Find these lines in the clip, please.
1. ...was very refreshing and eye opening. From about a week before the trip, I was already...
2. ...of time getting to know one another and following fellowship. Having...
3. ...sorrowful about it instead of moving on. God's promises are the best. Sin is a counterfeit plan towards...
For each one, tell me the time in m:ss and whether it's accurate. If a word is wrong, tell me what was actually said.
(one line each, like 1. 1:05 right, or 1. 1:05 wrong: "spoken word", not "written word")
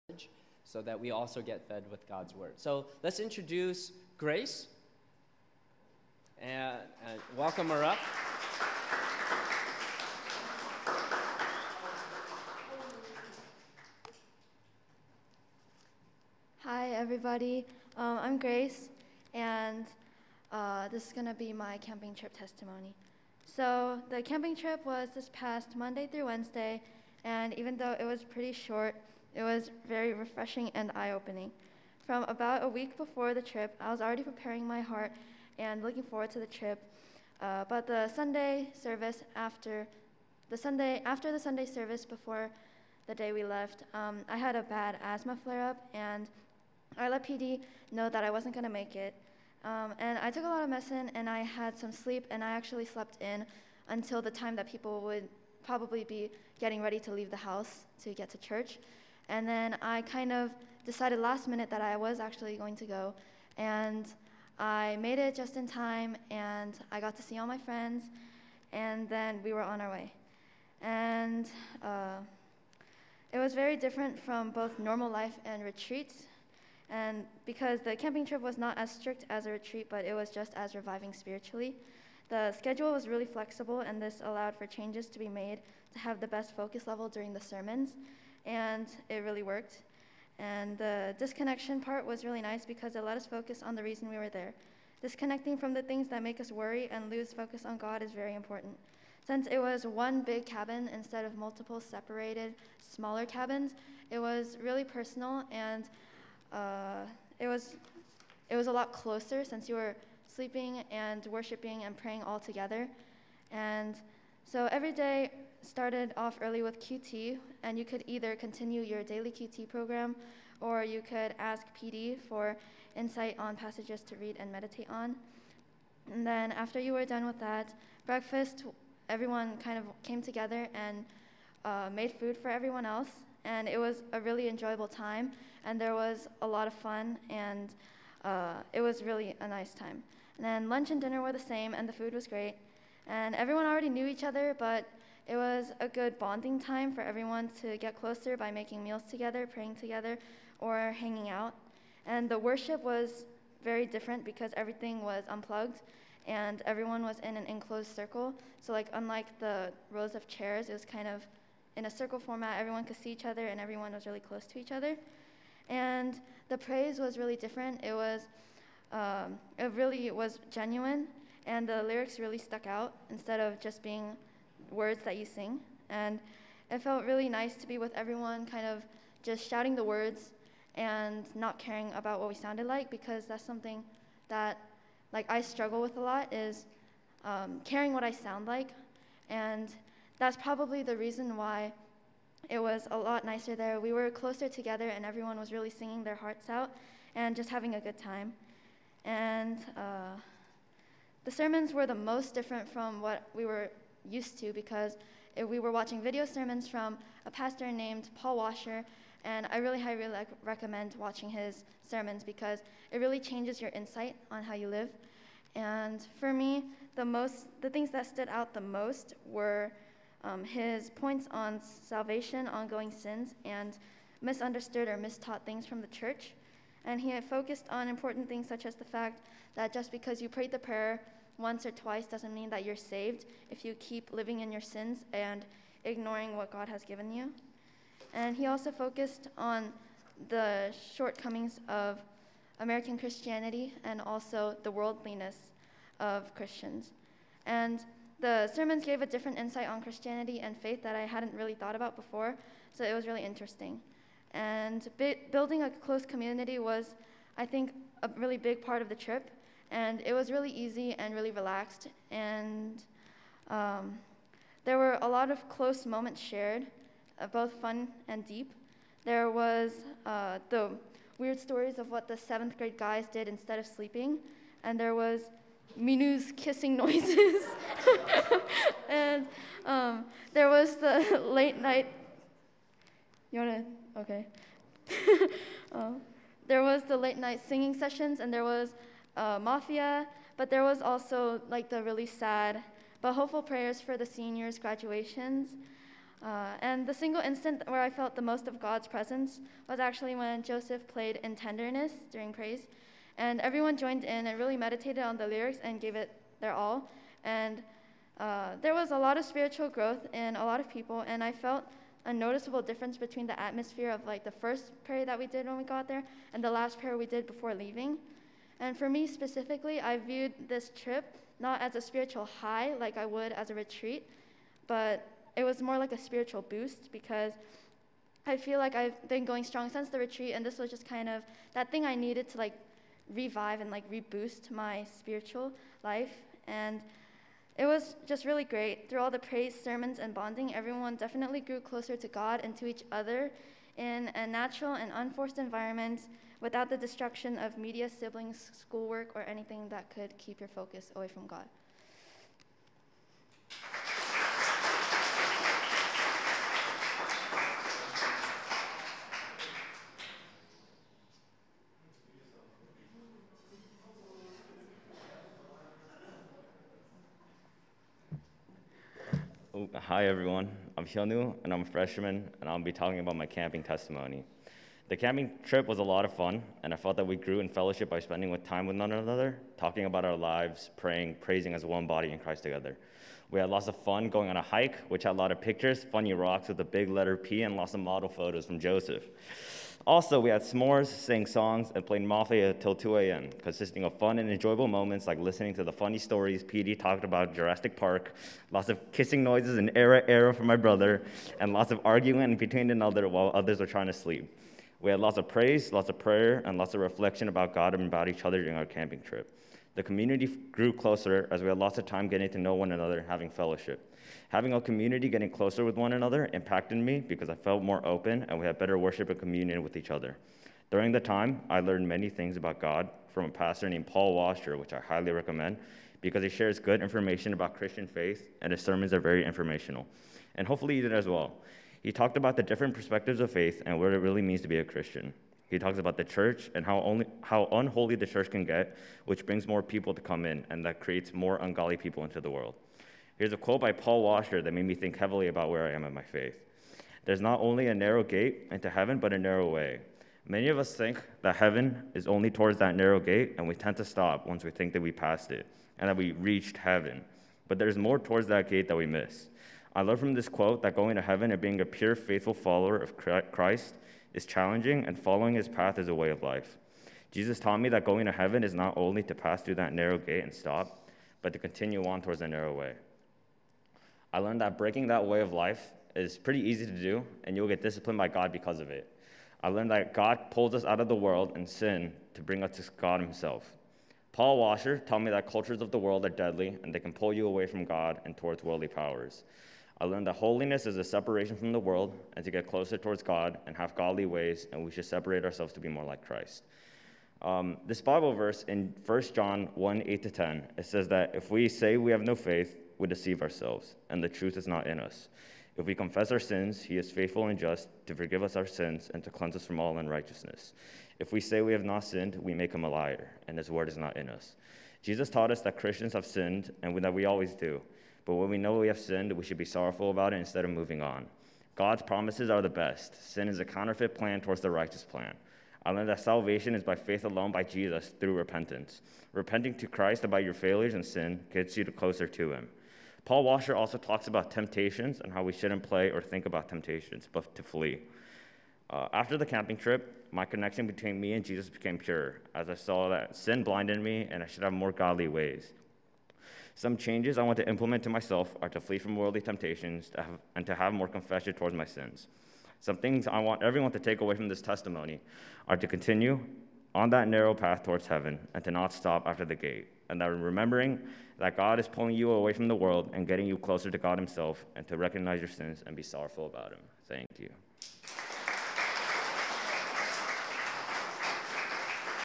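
1. 0:29 right
2. 6:51 wrong: "having", not "following"
3. 8:39 right.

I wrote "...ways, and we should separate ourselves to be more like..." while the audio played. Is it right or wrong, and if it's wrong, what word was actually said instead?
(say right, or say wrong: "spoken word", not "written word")
right.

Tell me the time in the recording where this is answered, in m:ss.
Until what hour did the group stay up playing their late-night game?
6:32.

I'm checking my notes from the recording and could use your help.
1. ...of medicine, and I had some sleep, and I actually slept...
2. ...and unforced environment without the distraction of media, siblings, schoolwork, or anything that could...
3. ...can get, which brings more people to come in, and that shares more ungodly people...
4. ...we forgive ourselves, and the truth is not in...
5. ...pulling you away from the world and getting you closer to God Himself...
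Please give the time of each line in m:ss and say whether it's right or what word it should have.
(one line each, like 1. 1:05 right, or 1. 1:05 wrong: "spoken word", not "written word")
1. 0:50 right
2. 5:44 right
3. 7:18 wrong: "creates", not "shares"
4. 8:22 wrong: "deceive", not "forgive"
5. 9:21 right.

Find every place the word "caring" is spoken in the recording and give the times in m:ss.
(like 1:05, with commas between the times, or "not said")
3:01, 3:07.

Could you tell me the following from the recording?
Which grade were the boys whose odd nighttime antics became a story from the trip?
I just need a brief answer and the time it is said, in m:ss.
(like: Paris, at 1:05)
7th grade, at 4:32.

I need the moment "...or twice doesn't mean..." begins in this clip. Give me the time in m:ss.
3:51.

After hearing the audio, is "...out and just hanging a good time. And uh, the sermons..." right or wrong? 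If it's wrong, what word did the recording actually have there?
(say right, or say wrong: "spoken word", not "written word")
wrong: "having", not "hanging".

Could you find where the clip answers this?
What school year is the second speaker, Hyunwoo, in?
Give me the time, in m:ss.
6:11.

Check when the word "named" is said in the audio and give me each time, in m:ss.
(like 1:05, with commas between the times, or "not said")
3:27, 7:03.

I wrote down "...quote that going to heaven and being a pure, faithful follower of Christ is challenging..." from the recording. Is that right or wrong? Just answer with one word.
right.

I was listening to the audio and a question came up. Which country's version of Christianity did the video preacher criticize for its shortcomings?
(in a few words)
American.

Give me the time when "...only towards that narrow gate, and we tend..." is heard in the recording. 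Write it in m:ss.
7:32.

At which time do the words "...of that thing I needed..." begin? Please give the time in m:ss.
5:31.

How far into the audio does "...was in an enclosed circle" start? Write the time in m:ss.
2:37.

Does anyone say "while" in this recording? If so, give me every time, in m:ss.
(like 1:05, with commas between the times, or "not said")
6:43.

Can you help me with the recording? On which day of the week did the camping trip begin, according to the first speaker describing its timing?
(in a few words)
Monday.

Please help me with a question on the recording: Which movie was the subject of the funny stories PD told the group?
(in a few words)
Jurassic Park.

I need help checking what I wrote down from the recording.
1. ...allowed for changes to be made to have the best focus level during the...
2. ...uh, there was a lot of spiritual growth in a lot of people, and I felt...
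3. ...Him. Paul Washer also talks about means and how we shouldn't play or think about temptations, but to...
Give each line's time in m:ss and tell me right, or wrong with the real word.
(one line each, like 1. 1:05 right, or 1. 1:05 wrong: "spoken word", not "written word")
1. 1:24 right
2. 5:08 right
3. 8:52 wrong: "temptations", not "means".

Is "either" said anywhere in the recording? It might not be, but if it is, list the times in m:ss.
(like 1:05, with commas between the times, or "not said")
1:58.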